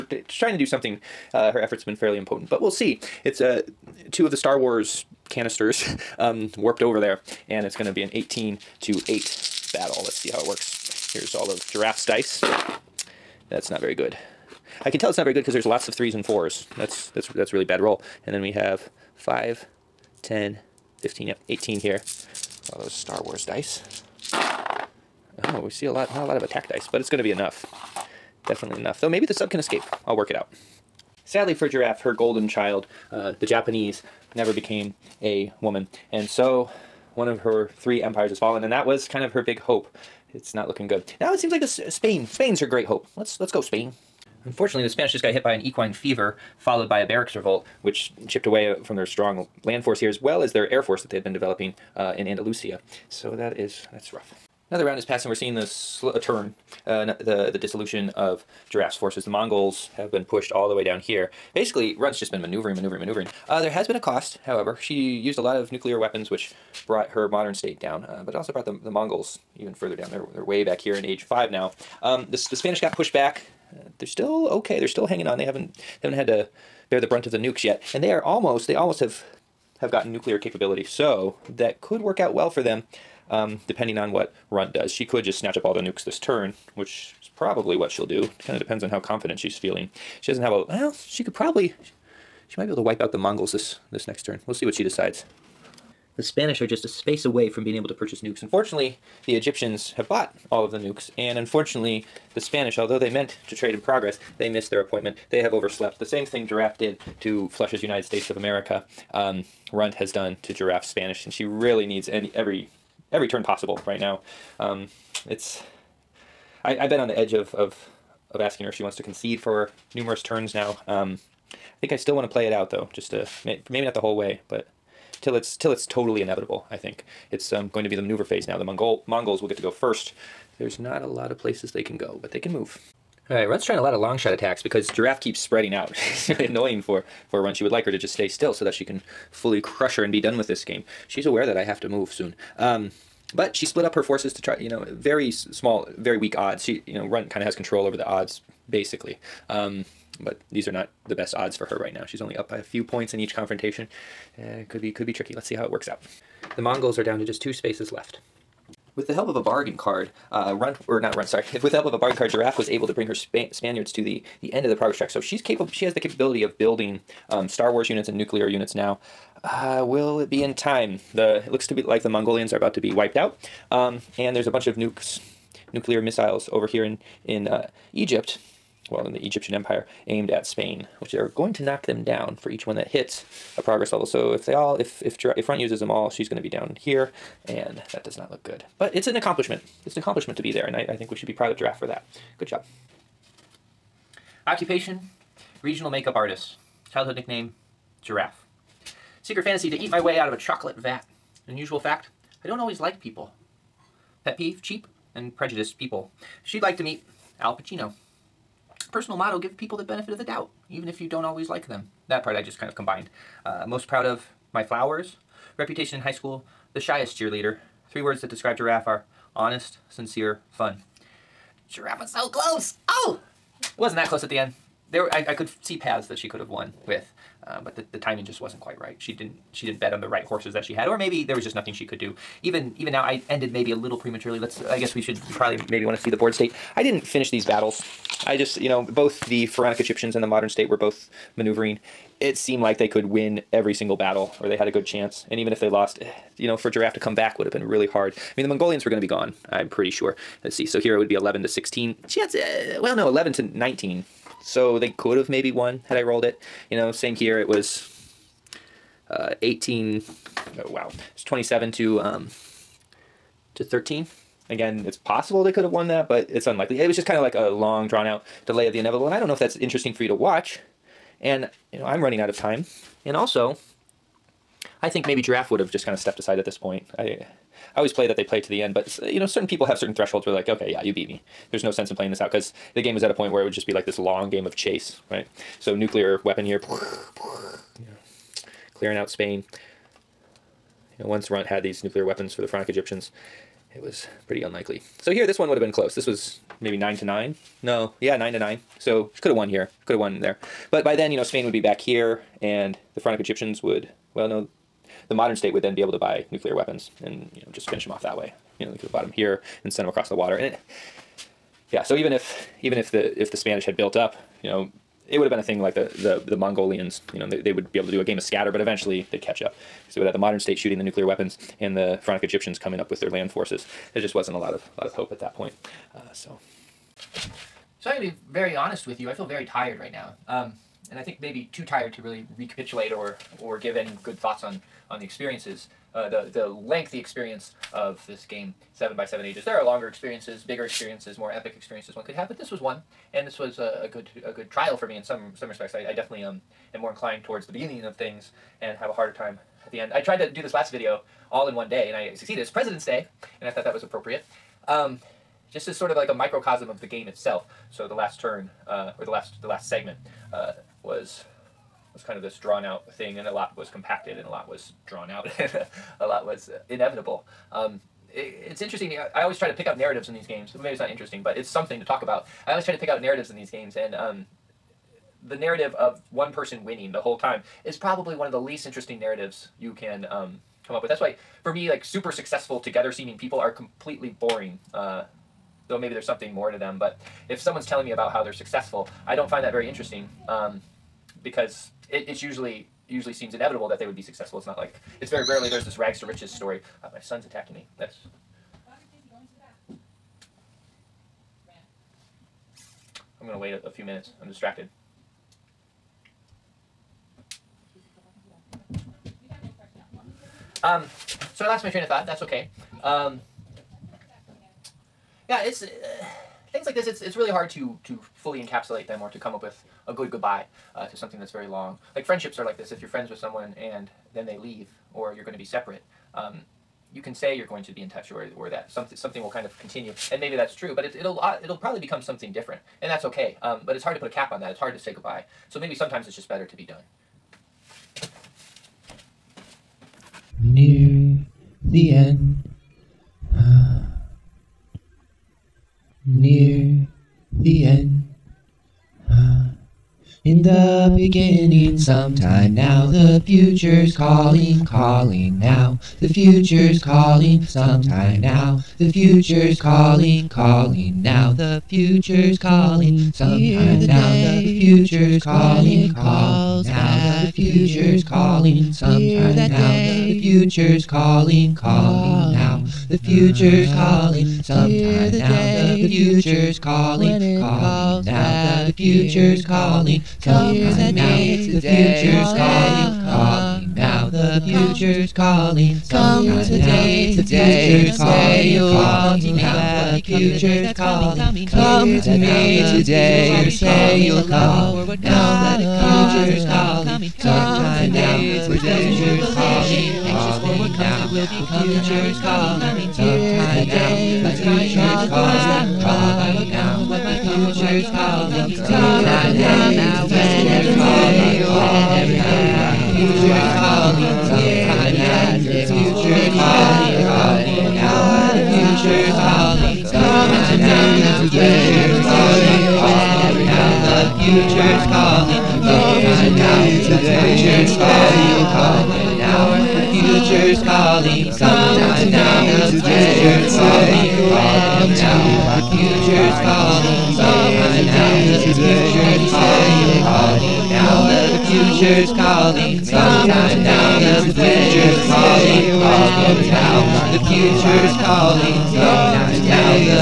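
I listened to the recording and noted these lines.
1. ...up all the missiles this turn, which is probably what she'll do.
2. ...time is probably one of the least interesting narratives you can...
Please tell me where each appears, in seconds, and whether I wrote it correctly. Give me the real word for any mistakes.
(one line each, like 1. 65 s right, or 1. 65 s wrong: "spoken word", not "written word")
1. 85 s wrong: "nukes", not "missiles"
2. 377 s right.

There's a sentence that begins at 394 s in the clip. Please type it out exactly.
It's not like it's very rarely there's this rags to riches story.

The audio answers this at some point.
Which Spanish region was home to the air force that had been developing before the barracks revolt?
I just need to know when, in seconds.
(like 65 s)
52 s.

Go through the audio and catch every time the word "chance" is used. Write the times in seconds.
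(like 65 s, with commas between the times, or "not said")
244 s, 252 s.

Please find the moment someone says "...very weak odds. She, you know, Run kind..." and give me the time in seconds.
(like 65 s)
145 s.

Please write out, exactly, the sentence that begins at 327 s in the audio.
So I'm gonna be very honest with you.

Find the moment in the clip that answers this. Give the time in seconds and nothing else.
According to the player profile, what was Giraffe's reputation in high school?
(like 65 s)
216 s.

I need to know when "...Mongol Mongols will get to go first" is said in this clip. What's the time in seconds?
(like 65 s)
128 s.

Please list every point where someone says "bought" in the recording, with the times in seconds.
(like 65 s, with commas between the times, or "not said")
100 s, 308 s.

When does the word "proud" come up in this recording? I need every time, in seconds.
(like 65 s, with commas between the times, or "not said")
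191 s, 213 s.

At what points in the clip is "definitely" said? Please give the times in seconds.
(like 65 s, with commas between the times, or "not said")
28 s, 345 s.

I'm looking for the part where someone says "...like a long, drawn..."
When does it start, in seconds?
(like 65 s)
267 s.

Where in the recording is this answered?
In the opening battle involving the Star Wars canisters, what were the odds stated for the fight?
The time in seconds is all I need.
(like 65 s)
8 s.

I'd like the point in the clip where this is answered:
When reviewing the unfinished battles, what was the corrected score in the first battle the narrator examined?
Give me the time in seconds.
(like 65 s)
253 s.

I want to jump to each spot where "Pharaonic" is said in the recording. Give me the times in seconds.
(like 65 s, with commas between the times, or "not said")
239 s, 292 s, 302 s, 322 s.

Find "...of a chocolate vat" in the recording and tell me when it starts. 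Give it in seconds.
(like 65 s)
200 s.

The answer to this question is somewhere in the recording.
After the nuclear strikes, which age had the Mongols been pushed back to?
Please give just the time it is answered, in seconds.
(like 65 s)
71 s.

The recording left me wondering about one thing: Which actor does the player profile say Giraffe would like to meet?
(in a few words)
Al Pacino.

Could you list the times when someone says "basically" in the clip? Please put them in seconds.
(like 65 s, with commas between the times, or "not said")
61 s, 148 s.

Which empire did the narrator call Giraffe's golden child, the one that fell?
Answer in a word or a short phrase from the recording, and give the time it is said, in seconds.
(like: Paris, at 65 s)
The Japanese, at 33 s.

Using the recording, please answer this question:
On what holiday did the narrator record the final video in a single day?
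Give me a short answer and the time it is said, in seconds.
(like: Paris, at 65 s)
President's Day, at 352 s.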